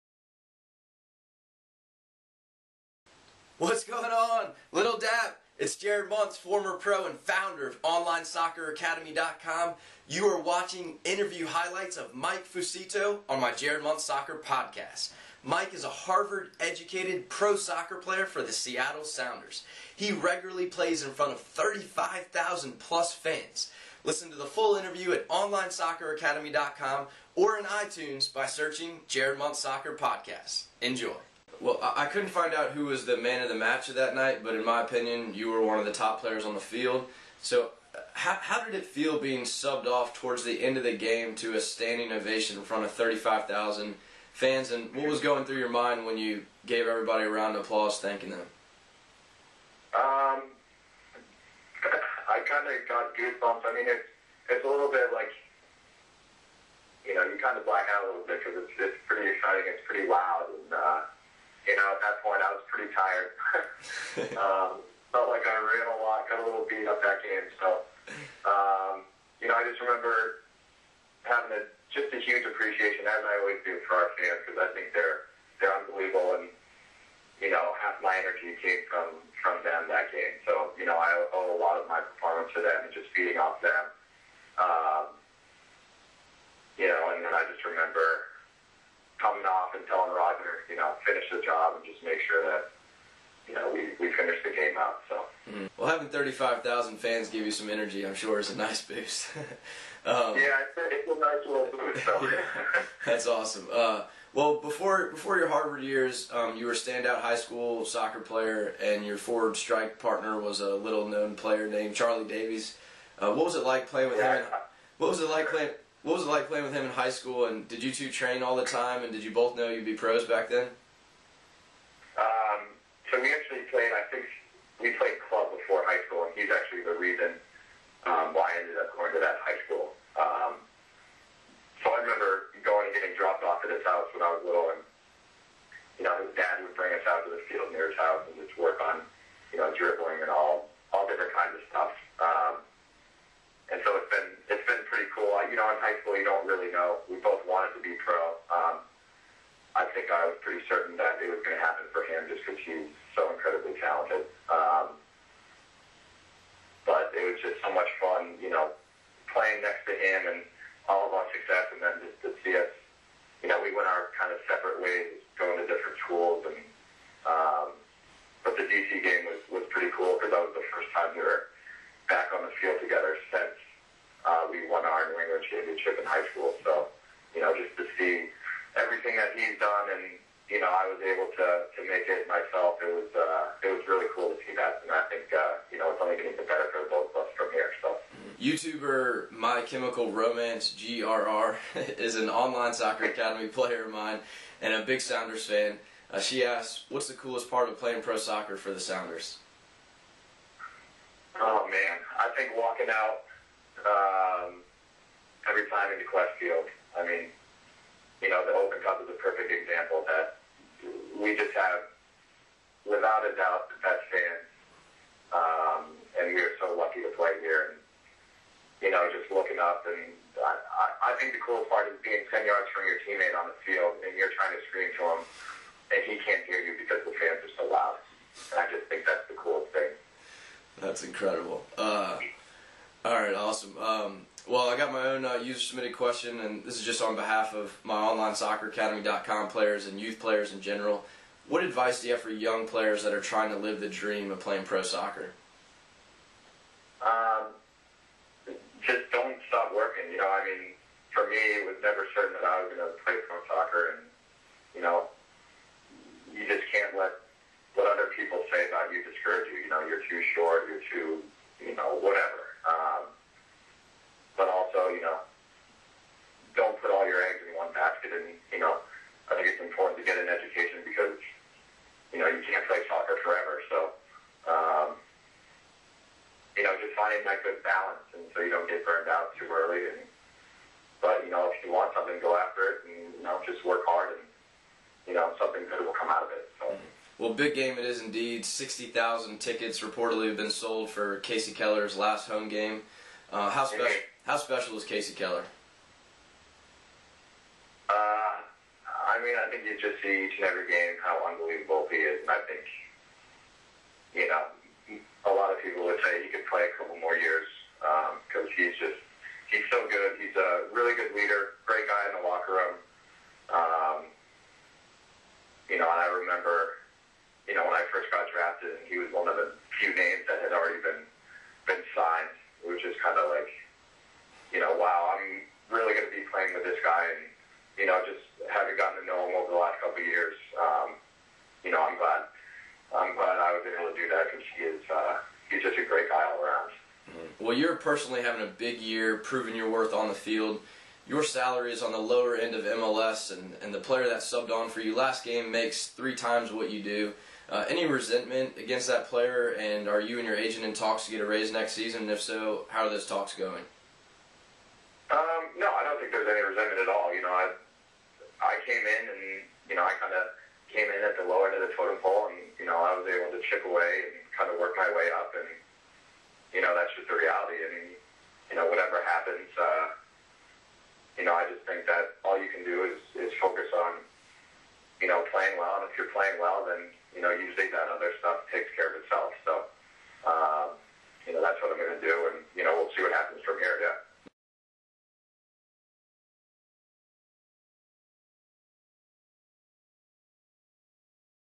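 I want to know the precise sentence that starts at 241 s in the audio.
What advice do you have for young players that are trying to live the dream of playing pro soccer?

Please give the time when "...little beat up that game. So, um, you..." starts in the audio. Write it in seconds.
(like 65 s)
66 s.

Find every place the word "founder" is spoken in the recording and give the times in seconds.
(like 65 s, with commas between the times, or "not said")
7 s.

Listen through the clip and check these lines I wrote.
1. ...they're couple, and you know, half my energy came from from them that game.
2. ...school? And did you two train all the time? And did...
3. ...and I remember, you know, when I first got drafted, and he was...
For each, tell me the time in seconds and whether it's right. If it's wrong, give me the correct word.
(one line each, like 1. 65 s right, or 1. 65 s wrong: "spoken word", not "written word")
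1. 75 s wrong: "unbelievable", not "couple"
2. 117 s right
3. 315 s right.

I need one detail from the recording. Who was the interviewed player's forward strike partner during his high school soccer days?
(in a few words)
Charlie Davies.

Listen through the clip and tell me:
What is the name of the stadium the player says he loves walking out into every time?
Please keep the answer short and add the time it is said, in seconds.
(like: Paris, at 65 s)
Qwest Field, at 206 s.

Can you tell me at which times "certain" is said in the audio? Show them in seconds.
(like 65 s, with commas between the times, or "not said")
150 s, 252 s.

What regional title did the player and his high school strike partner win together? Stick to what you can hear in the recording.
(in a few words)
New England championship.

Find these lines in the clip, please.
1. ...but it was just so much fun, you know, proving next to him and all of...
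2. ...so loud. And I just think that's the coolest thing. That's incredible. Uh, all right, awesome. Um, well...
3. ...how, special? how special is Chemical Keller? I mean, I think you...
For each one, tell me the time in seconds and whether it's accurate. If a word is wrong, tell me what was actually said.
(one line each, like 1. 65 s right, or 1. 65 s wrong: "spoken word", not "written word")
1. 156 s wrong: "playing", not "proving"
2. 227 s right
3. 293 s wrong: "Casey", not "Chemical".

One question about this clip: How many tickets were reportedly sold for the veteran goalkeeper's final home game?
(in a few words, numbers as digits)
60,000.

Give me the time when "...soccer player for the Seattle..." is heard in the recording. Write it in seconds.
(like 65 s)
17 s.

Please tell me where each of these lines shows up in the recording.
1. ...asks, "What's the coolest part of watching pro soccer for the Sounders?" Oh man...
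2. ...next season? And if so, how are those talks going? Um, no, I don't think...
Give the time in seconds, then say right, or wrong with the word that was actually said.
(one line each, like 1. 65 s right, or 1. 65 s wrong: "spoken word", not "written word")
1. 196 s wrong: "playing", not "watching"
2. 351 s right.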